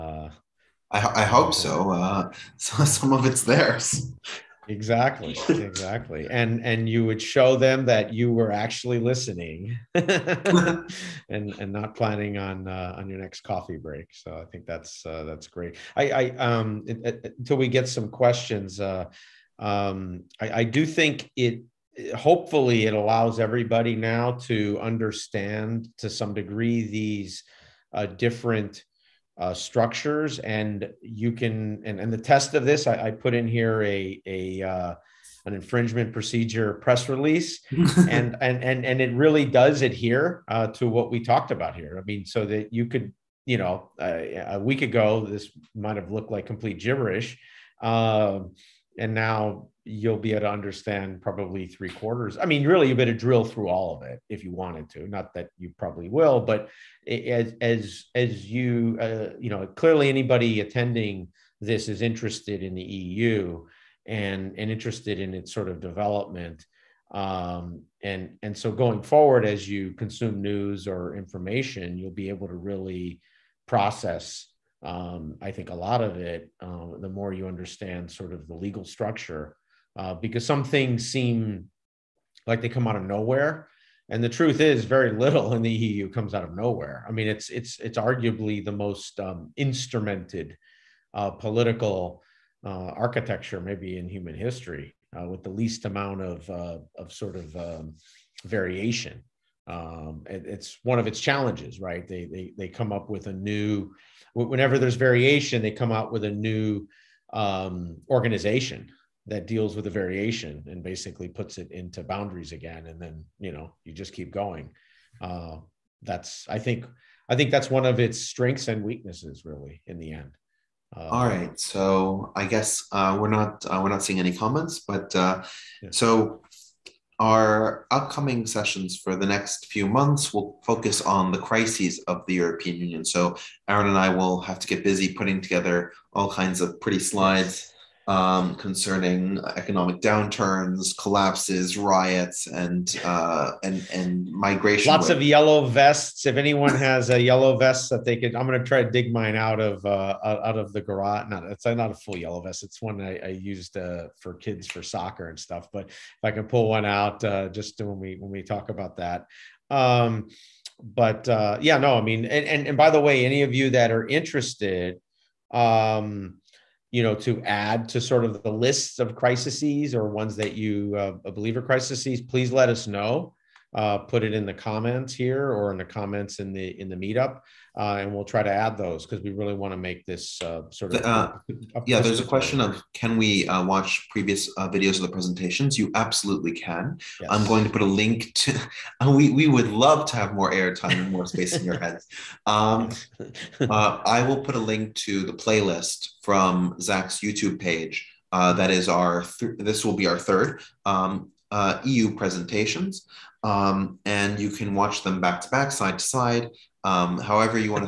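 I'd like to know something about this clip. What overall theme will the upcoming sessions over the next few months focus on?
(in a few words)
Crises of the European Union.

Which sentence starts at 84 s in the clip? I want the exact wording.
And the truth is, very little in the EU comes out of nowhere.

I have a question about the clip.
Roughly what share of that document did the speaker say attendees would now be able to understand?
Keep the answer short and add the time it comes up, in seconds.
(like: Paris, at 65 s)
Three quarters, at 51 s.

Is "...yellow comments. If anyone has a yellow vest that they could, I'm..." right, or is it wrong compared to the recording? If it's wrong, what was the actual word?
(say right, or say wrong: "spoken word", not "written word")
wrong: "vests", not "comments".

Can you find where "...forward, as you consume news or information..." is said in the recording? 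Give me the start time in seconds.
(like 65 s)
69 s.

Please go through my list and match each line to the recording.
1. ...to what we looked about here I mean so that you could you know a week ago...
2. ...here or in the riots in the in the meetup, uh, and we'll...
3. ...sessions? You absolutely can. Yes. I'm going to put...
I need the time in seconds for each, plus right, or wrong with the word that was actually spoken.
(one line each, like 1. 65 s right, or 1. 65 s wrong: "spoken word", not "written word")
1. 40 s wrong: "talked", not "looked"
2. 175 s wrong: "comments", not "riots"
3. 185 s wrong: "presentations", not "sessions".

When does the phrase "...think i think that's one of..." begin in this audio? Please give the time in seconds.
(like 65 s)
116 s.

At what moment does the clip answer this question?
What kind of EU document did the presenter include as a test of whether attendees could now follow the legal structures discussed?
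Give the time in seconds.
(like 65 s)
35 s.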